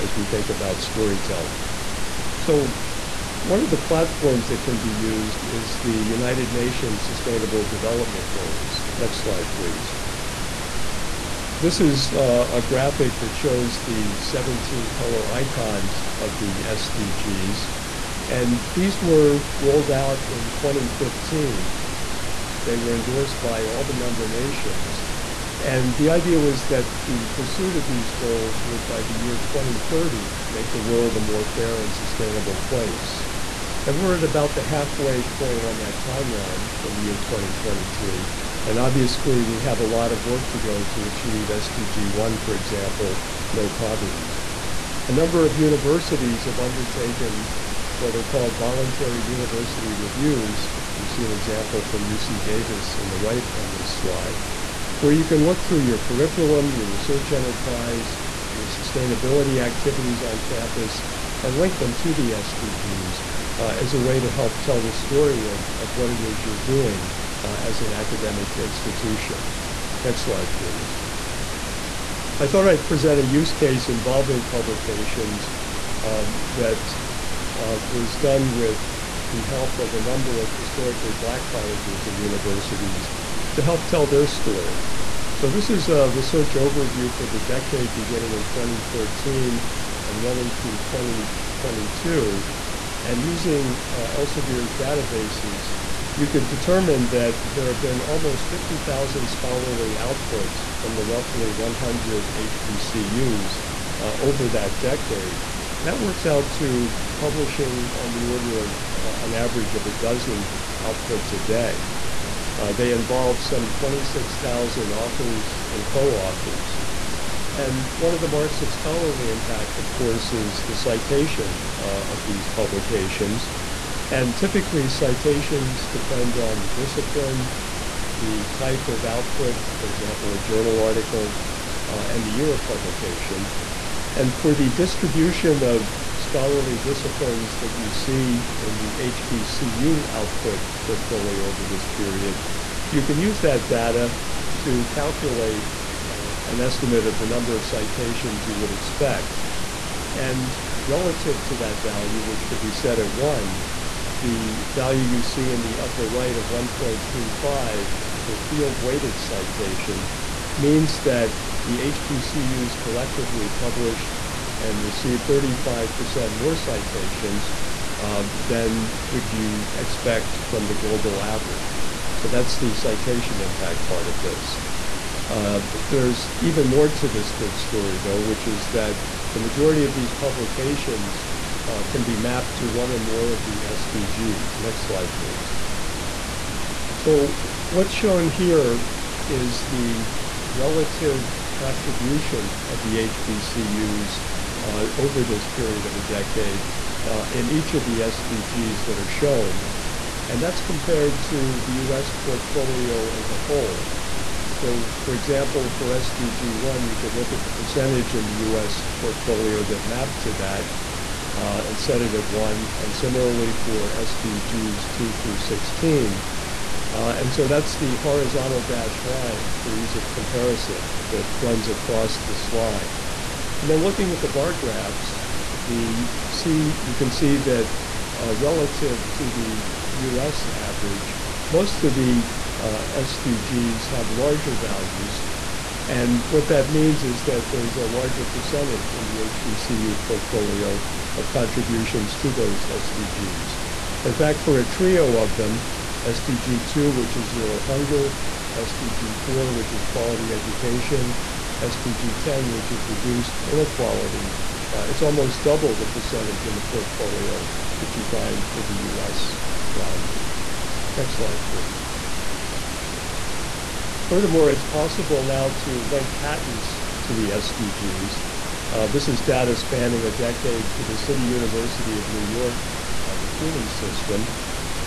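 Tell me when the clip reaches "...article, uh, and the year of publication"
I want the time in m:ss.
2:10.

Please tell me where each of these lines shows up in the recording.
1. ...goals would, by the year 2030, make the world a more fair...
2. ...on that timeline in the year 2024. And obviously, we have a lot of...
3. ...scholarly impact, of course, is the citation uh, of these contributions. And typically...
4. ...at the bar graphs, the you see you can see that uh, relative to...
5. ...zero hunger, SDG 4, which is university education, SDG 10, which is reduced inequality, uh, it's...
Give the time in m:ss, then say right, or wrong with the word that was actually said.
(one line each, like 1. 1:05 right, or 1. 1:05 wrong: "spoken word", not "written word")
1. 0:28 right
2. 0:35 wrong: "2023", not "2024"
3. 1:58 wrong: "publications", not "contributions"
4. 3:44 right
5. 4:07 wrong: "quality", not "university".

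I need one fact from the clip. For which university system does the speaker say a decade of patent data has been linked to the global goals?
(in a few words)
City University of New York.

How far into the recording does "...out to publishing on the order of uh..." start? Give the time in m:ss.
1:46.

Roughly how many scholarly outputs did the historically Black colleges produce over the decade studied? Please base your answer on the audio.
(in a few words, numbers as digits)
almost 50,000.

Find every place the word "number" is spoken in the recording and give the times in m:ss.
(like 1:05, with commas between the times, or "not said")
0:45, 1:20, 2:27.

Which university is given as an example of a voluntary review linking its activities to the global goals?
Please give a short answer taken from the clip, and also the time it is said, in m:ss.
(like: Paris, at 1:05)
UC Davis, at 0:52.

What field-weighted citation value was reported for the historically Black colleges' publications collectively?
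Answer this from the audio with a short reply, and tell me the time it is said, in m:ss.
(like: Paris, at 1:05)
1.35, at 2:36.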